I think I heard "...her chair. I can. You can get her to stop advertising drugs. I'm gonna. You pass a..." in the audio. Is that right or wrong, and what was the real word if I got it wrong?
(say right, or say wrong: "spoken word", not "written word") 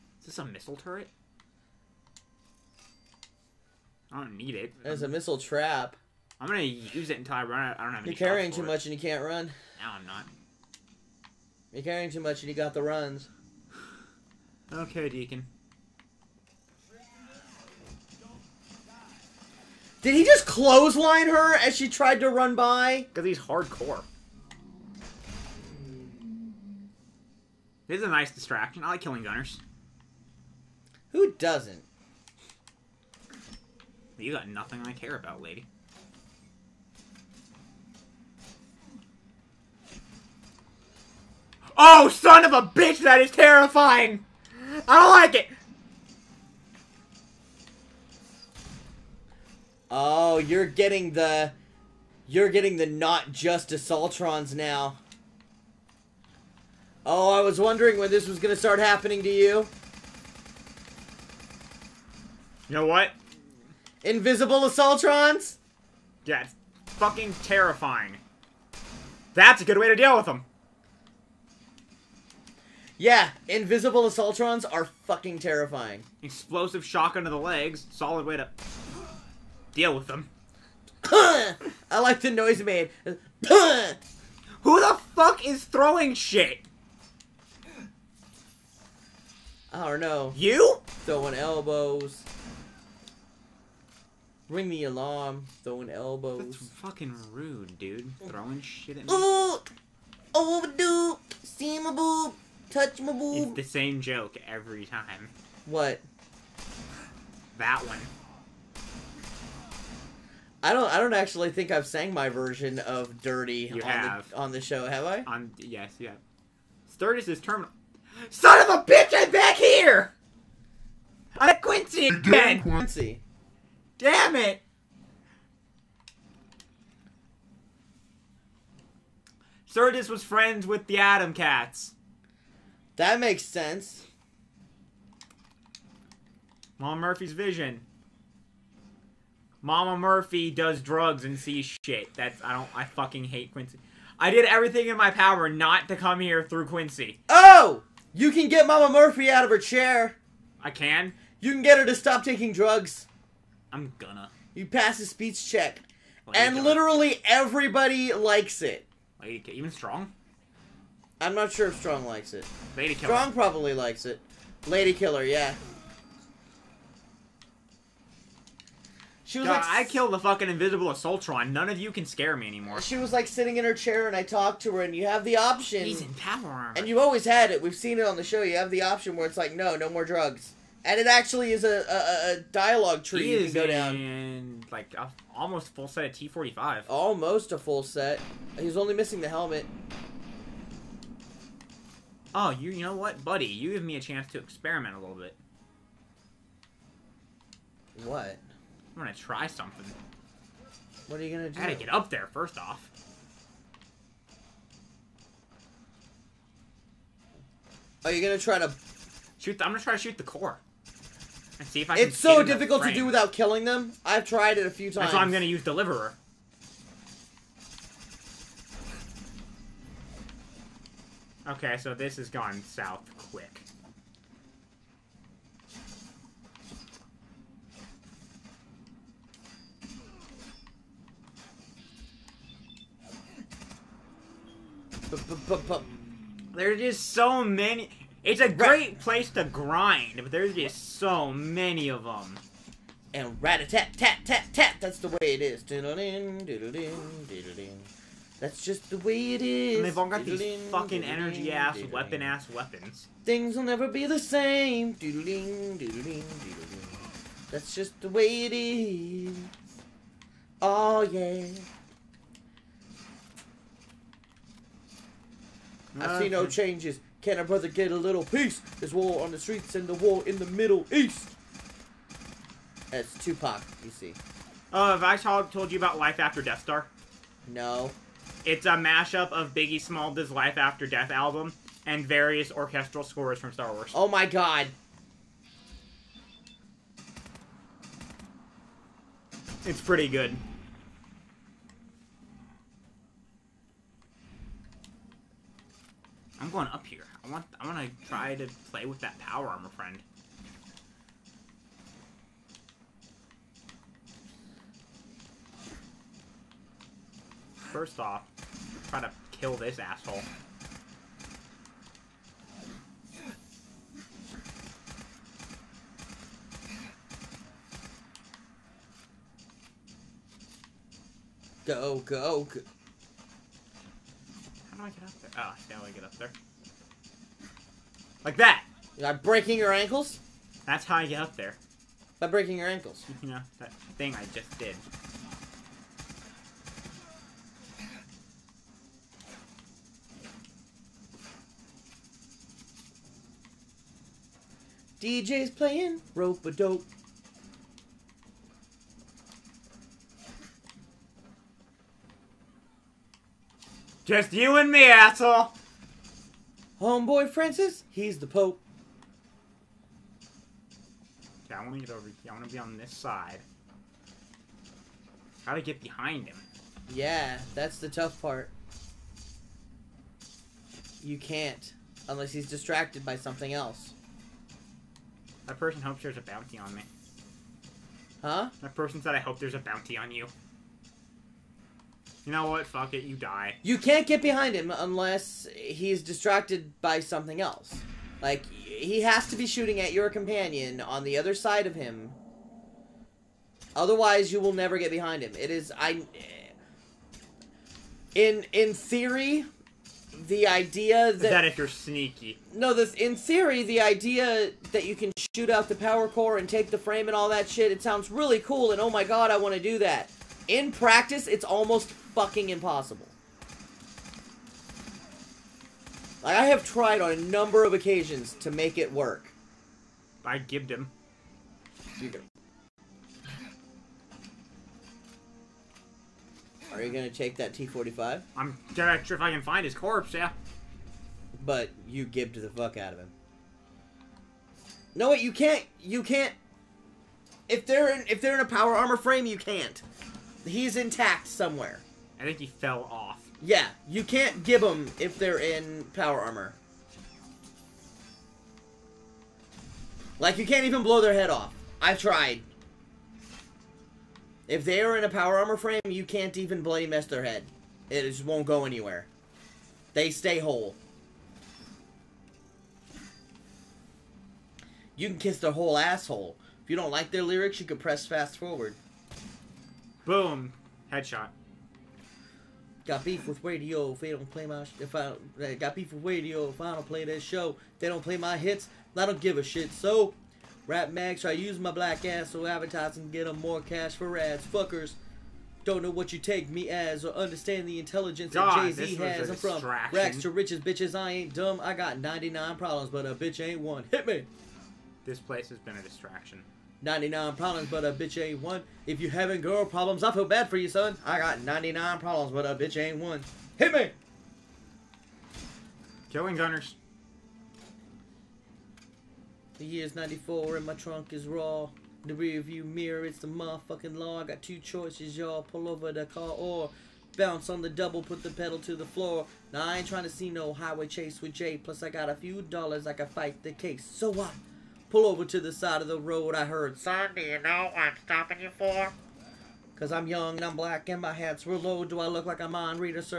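wrong: "taking", not "advertising".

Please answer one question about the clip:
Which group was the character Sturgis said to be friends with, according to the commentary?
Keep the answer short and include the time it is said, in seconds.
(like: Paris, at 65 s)
the Atom Cats, at 130 s.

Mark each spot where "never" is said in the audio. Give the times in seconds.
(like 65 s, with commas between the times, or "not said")
253 s, 394 s.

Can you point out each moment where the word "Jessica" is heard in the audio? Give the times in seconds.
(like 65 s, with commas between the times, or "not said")
not said.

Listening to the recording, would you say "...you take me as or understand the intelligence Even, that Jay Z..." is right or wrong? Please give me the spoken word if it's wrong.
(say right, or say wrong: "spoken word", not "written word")
wrong: "God", not "Even".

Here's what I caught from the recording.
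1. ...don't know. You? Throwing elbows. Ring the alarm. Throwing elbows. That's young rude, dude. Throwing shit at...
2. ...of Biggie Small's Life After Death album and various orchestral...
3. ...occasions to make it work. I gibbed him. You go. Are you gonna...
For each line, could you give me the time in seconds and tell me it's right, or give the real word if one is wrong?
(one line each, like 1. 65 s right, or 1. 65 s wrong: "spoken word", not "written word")
1. 89 s wrong: "fucking", not "young"
2. 279 s right
3. 417 s right.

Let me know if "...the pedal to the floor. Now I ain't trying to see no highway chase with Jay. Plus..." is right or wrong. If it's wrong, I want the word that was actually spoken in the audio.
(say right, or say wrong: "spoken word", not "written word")
right.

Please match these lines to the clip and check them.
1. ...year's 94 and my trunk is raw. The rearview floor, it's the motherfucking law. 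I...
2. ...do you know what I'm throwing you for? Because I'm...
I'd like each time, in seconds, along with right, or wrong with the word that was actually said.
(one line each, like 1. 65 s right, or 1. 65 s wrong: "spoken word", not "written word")
1. 509 s wrong: "mirror", not "floor"
2. 527 s wrong: "stopping", not "throwing".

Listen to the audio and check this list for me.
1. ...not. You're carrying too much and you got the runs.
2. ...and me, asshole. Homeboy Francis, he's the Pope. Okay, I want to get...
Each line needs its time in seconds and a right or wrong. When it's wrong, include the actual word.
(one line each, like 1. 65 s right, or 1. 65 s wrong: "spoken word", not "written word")
1. 10 s right
2. 354 s right.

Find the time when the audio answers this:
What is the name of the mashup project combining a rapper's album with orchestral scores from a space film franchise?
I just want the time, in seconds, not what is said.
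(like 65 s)
275 s.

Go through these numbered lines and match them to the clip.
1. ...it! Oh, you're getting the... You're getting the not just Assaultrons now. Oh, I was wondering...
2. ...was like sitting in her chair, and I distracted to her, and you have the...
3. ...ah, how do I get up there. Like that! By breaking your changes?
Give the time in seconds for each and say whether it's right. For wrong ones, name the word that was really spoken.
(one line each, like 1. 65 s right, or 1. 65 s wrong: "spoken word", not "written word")
1. 45 s right
2. 172 s wrong: "talked", not "distracted"
3. 325 s wrong: "ankles", not "changes".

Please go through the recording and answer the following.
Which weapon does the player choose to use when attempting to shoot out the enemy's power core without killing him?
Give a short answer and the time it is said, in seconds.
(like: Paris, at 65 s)
Deliverer, at 215 s.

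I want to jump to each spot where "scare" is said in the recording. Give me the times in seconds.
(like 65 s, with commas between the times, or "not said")
172 s.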